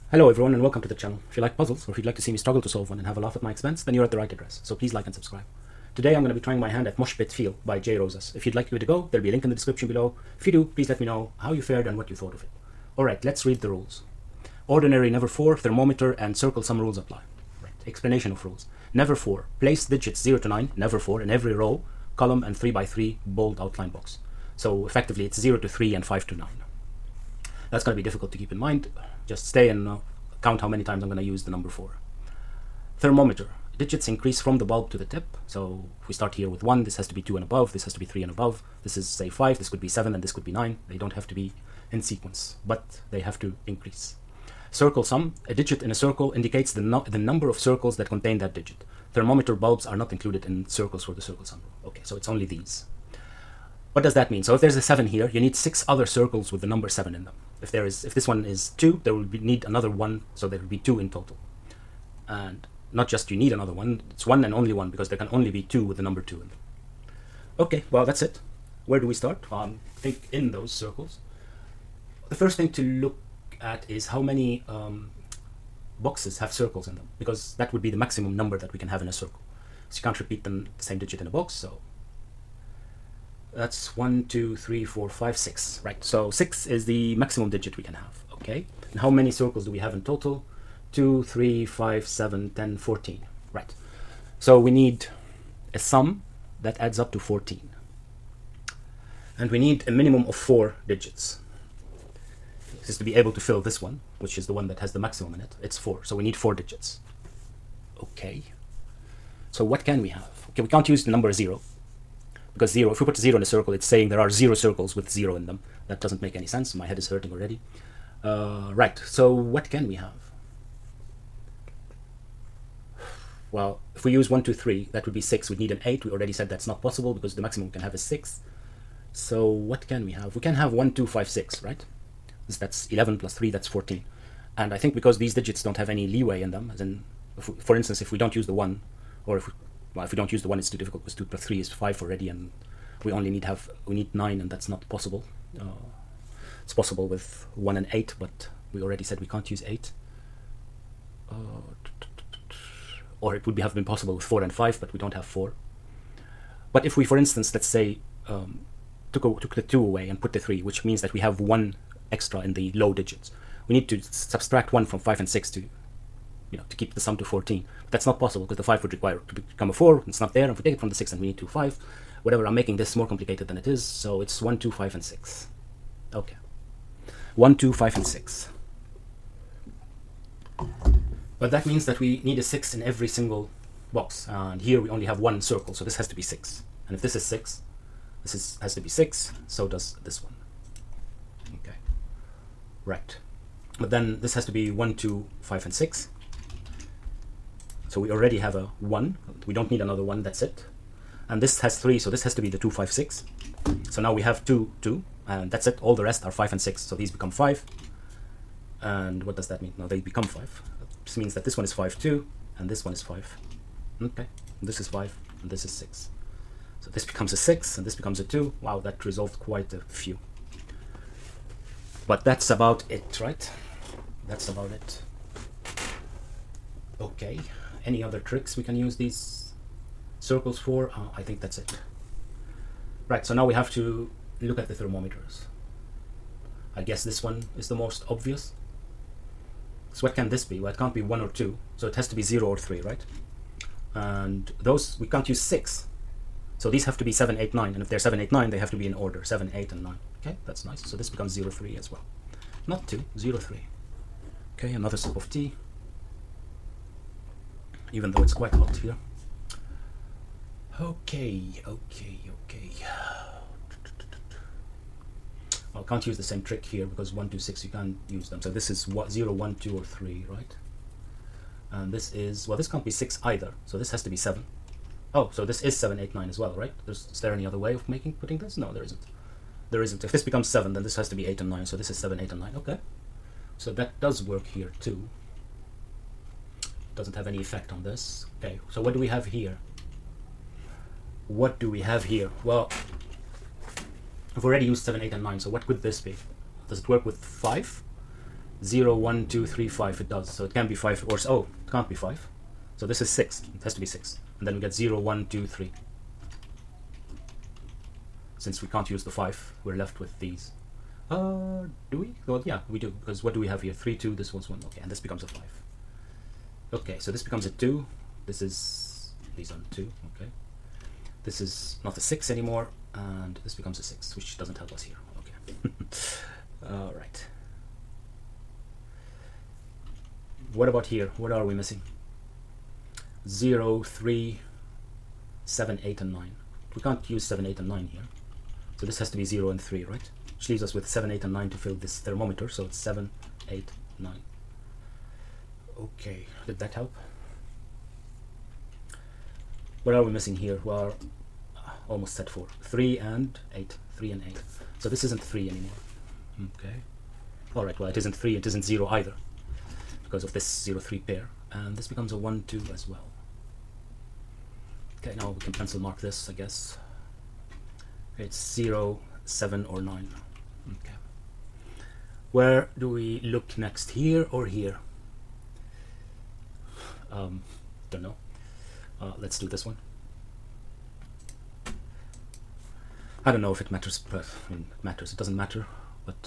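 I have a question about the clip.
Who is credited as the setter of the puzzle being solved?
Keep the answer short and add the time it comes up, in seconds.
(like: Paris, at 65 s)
Jay Rosas, at 7 s.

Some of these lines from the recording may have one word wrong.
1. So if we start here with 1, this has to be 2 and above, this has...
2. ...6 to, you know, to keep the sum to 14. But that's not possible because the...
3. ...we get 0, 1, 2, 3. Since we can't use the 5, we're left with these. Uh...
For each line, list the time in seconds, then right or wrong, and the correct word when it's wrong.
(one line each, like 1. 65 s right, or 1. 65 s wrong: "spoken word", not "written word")
1. 35 s right
2. 165 s right
3. 304 s right.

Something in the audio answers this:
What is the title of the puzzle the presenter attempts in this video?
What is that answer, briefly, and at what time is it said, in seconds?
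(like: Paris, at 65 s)
Mosh Pit Feel, at 6 s.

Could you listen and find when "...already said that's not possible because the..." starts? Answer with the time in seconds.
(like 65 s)
126 s.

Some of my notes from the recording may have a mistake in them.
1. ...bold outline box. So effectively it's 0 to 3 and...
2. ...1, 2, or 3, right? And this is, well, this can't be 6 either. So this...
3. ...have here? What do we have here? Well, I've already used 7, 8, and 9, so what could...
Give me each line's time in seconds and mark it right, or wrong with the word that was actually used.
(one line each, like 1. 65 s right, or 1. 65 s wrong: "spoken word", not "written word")
1. 23 s right
2. 269 s right
3. 289 s right.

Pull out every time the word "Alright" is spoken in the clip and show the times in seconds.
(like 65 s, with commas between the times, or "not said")
12 s, 357 s.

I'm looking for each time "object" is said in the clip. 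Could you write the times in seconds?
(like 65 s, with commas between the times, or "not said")
not said.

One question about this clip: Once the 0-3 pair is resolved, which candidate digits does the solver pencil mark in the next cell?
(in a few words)
0, 7 or 9.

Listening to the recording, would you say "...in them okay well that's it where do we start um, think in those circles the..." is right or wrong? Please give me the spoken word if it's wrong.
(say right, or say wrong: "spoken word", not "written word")
right.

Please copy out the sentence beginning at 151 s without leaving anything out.
Uh, or it would be, have been possible with 4 and 5, but we don't have 4.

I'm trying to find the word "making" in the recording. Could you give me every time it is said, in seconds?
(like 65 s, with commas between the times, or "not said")
172 s, 277 s.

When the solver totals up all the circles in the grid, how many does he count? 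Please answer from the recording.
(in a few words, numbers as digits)
14.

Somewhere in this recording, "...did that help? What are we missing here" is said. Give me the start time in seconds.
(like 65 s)
346 s.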